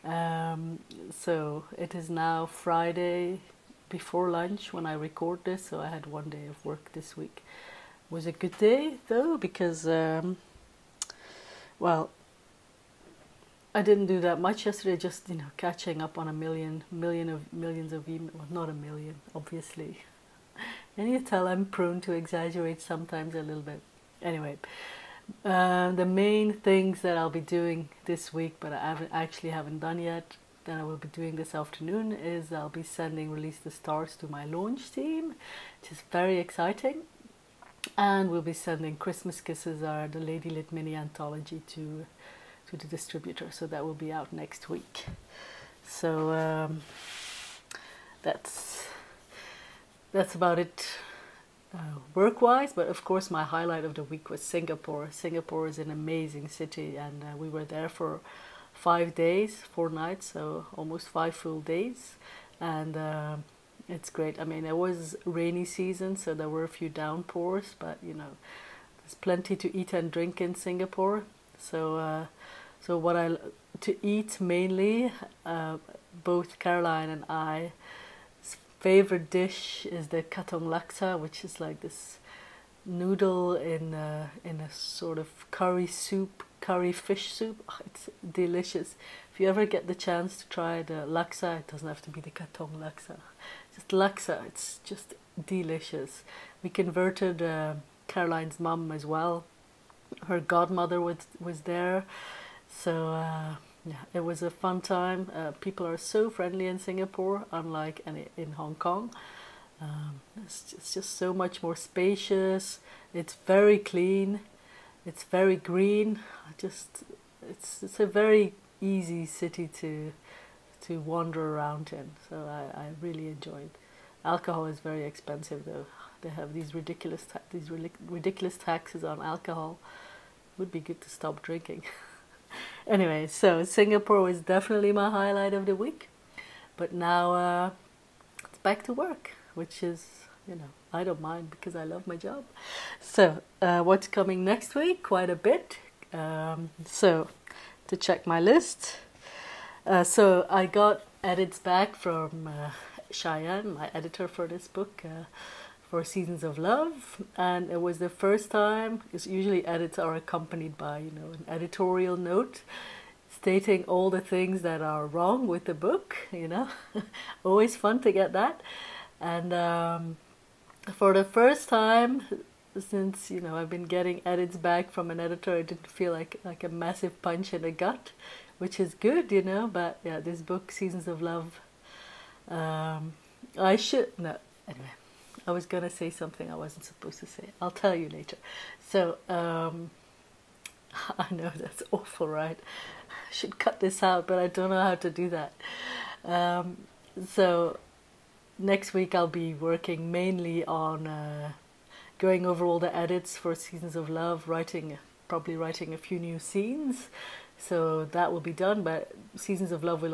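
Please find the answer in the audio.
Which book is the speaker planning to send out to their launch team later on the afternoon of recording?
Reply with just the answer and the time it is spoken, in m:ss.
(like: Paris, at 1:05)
Release the Stars, at 0:33.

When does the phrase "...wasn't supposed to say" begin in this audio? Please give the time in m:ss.
3:06.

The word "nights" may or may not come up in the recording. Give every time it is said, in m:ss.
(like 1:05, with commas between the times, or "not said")
0:59.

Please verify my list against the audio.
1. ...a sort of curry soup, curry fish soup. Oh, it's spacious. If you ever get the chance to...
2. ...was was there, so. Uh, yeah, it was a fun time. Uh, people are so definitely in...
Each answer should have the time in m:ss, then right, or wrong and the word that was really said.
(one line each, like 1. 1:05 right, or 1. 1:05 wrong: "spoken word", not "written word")
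1. 1:24 wrong: "delicious", not "spacious"
2. 1:41 wrong: "friendly", not "definitely".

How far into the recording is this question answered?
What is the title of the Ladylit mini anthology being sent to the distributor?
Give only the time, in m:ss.
0:38.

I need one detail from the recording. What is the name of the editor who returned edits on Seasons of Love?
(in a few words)
Cheyenne.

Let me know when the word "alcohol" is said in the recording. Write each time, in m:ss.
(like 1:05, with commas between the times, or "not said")
2:04, 2:09.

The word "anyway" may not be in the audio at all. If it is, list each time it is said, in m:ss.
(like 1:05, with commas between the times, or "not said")
0:24, 2:12, 3:04.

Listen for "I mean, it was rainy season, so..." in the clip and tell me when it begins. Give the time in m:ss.
1:04.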